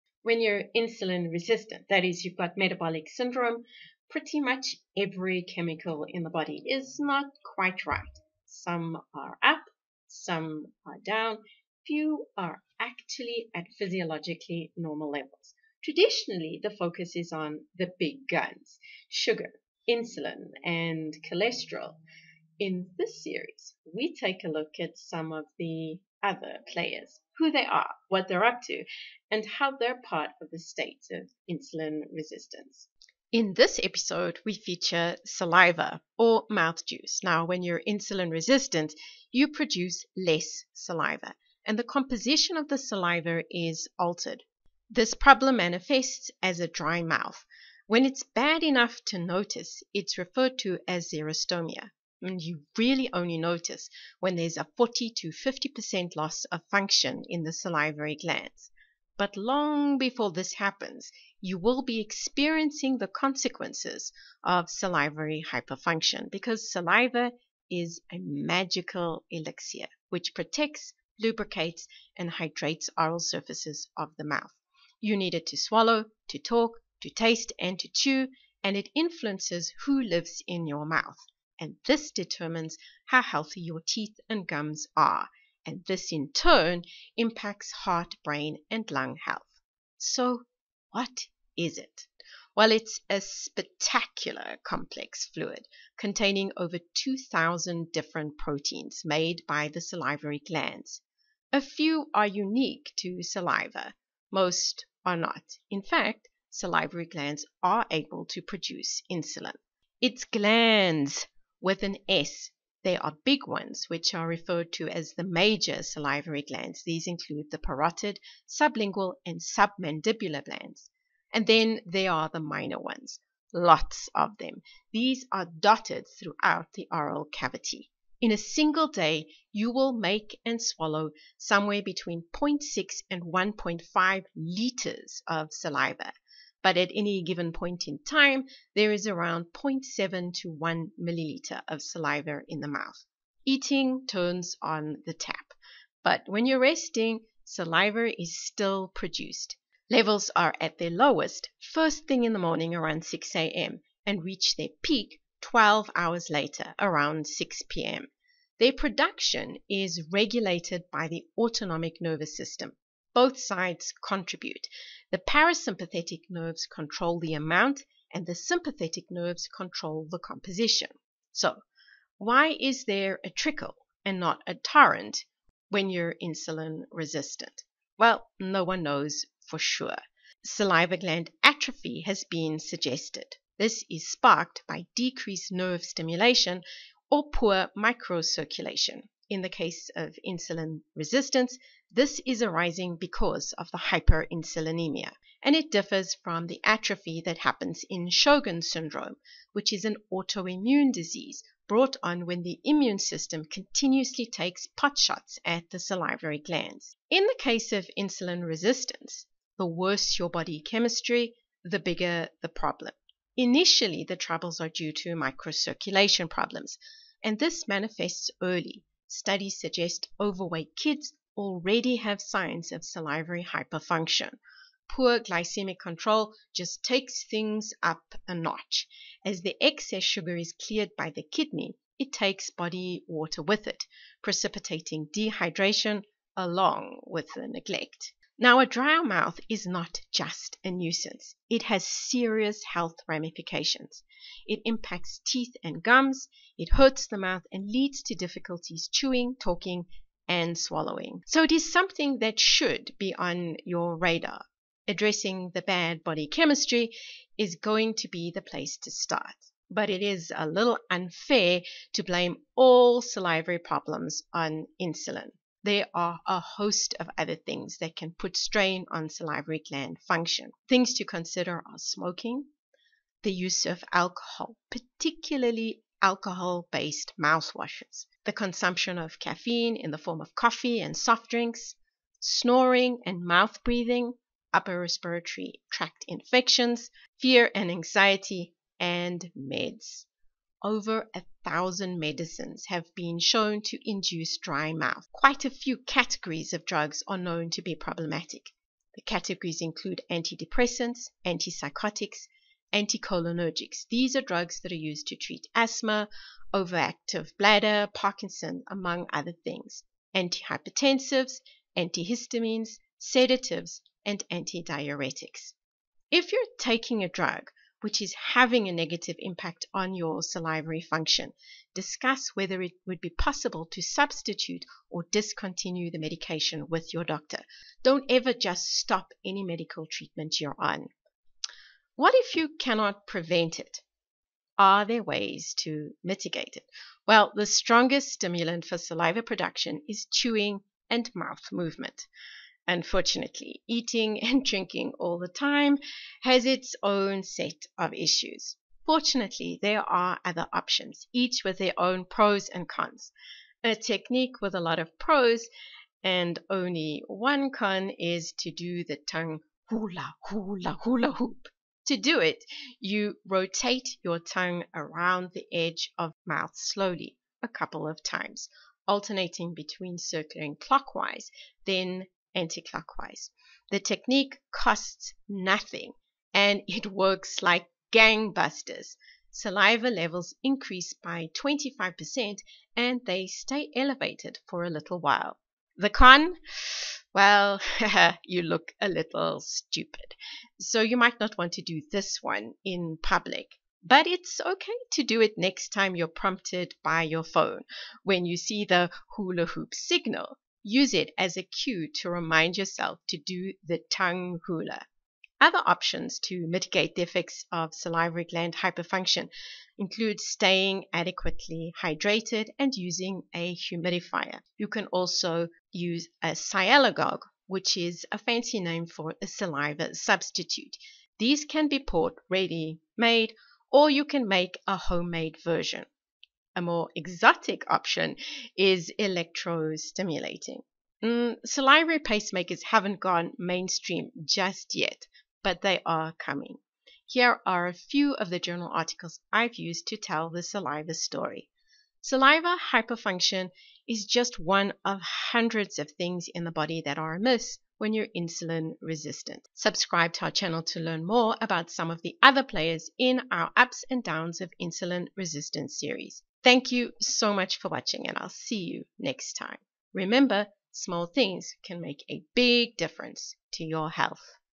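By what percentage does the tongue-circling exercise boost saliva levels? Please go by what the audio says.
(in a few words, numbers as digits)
25%.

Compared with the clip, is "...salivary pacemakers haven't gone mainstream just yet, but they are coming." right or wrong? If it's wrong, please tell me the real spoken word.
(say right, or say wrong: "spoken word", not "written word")
right.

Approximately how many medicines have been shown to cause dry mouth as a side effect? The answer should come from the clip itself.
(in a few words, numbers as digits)
over a thousand.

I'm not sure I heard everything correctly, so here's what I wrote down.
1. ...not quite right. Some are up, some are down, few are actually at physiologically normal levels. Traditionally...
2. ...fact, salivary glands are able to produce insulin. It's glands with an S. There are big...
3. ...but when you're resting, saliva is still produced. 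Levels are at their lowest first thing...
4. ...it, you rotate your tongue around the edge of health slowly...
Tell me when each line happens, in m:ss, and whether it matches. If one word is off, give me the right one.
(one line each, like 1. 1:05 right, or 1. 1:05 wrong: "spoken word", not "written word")
1. 0:06 right
2. 1:45 right
3. 2:26 right
4. 6:02 wrong: "mouth", not "health".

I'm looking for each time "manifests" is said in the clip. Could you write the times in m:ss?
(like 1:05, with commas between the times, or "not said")
0:45, 3:37.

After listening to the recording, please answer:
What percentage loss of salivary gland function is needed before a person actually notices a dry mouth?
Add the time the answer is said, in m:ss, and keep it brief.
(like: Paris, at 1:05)
40 to 50%, at 0:54.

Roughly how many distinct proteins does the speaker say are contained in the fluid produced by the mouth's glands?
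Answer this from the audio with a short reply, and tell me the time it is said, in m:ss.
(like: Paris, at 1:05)
over 2,000, at 1:36.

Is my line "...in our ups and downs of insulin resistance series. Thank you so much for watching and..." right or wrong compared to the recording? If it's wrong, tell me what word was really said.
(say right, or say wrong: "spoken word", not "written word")
right.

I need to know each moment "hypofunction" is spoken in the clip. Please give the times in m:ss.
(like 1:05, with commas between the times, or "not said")
1:05, 3:43, 6:48, 7:22.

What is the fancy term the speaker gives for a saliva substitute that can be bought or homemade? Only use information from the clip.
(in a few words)
sialogogue.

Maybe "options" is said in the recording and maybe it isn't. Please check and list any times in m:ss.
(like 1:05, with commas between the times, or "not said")
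5:50, 6:45, 7:07.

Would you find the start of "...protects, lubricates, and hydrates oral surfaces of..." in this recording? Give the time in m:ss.
1:10.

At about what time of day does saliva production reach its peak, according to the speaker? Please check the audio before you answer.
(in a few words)
6 p.m.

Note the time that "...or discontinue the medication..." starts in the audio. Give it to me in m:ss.
5:24.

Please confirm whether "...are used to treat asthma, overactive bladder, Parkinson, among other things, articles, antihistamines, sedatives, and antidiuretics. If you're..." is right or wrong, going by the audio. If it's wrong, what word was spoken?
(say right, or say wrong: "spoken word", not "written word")
wrong: "antihypertensives", not "articles".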